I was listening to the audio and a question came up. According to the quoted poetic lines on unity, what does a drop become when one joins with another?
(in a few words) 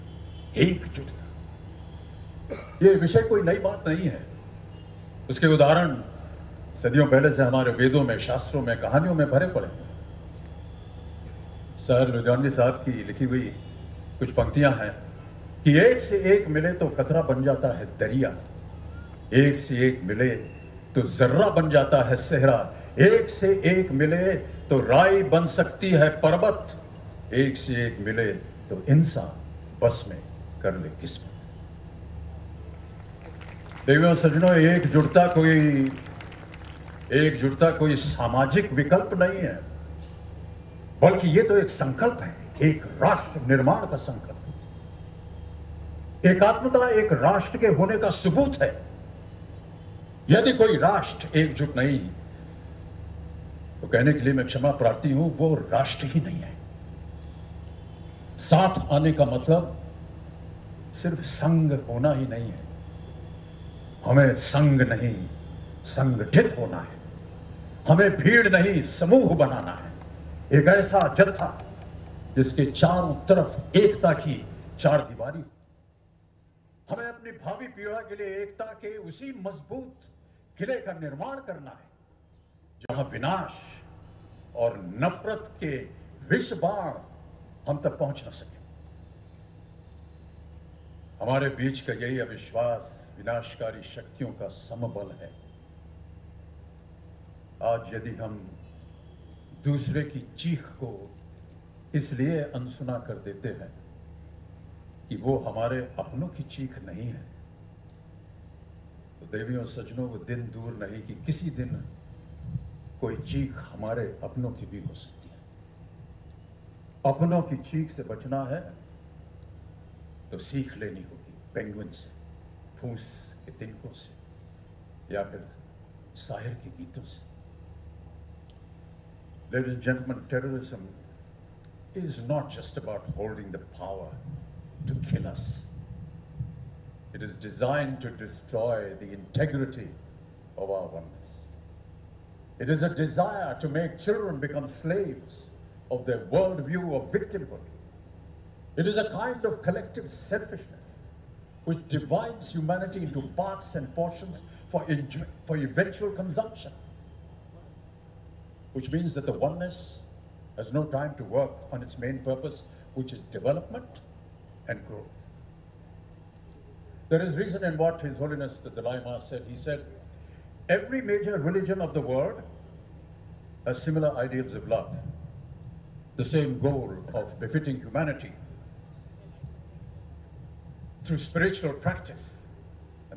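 दरिया.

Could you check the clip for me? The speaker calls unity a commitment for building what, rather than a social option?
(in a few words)
राष्ट्र निर्माण.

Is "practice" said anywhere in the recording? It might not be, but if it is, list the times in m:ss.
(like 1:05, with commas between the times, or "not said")
3:01.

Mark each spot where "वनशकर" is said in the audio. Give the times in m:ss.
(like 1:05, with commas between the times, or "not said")
1:33.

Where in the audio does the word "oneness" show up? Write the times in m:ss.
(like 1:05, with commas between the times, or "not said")
2:20, 2:39.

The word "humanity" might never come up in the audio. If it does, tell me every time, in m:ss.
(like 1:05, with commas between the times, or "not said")
2:32, 2:57.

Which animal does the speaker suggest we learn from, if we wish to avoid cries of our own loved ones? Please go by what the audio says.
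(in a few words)
पेंगुइन.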